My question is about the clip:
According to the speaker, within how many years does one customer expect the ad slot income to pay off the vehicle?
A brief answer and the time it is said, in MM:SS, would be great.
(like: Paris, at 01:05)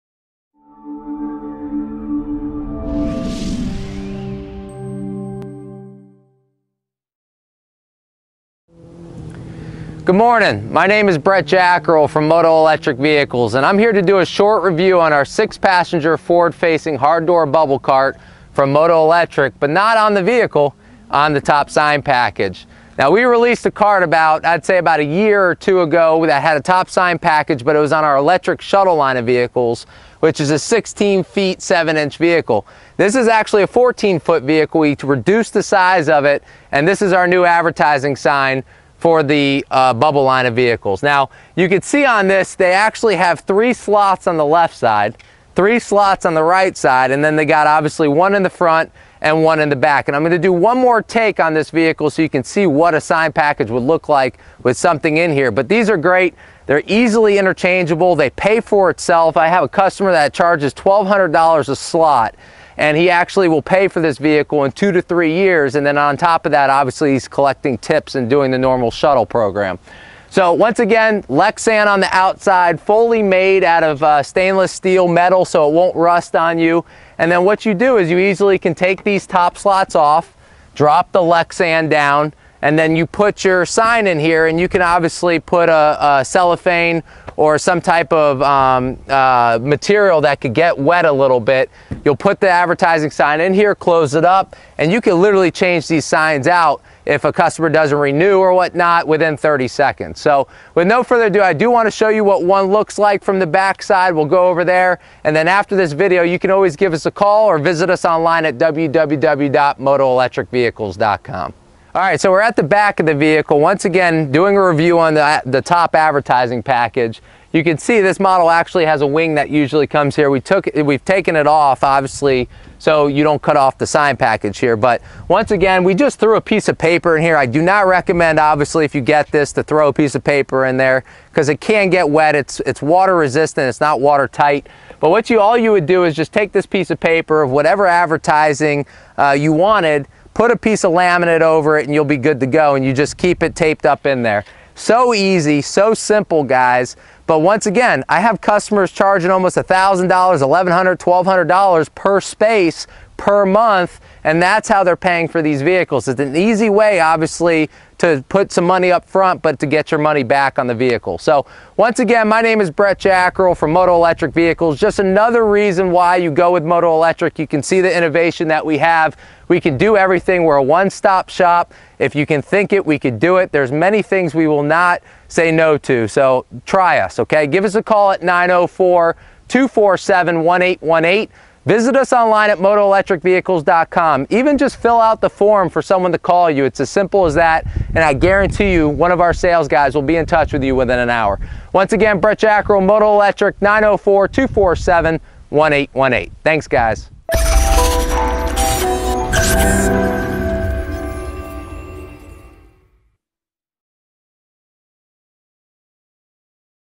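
2 to 3 years, at 01:04.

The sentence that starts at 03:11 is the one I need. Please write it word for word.
Once again, Brett Jackrell, Moto Electric, 904-247-1818.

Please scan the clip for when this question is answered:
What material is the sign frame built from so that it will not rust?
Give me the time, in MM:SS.
01:14.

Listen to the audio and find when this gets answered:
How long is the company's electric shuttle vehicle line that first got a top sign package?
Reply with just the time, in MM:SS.
00:30.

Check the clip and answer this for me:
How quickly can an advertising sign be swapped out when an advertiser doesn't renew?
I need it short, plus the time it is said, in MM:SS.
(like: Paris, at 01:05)
30 seconds, at 01:39.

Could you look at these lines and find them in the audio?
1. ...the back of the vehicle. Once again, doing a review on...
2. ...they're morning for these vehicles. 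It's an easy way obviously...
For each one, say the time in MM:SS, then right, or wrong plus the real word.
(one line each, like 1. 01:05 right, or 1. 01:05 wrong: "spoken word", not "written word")
1. 01:52 right
2. 02:34 wrong: "paying", not "morning".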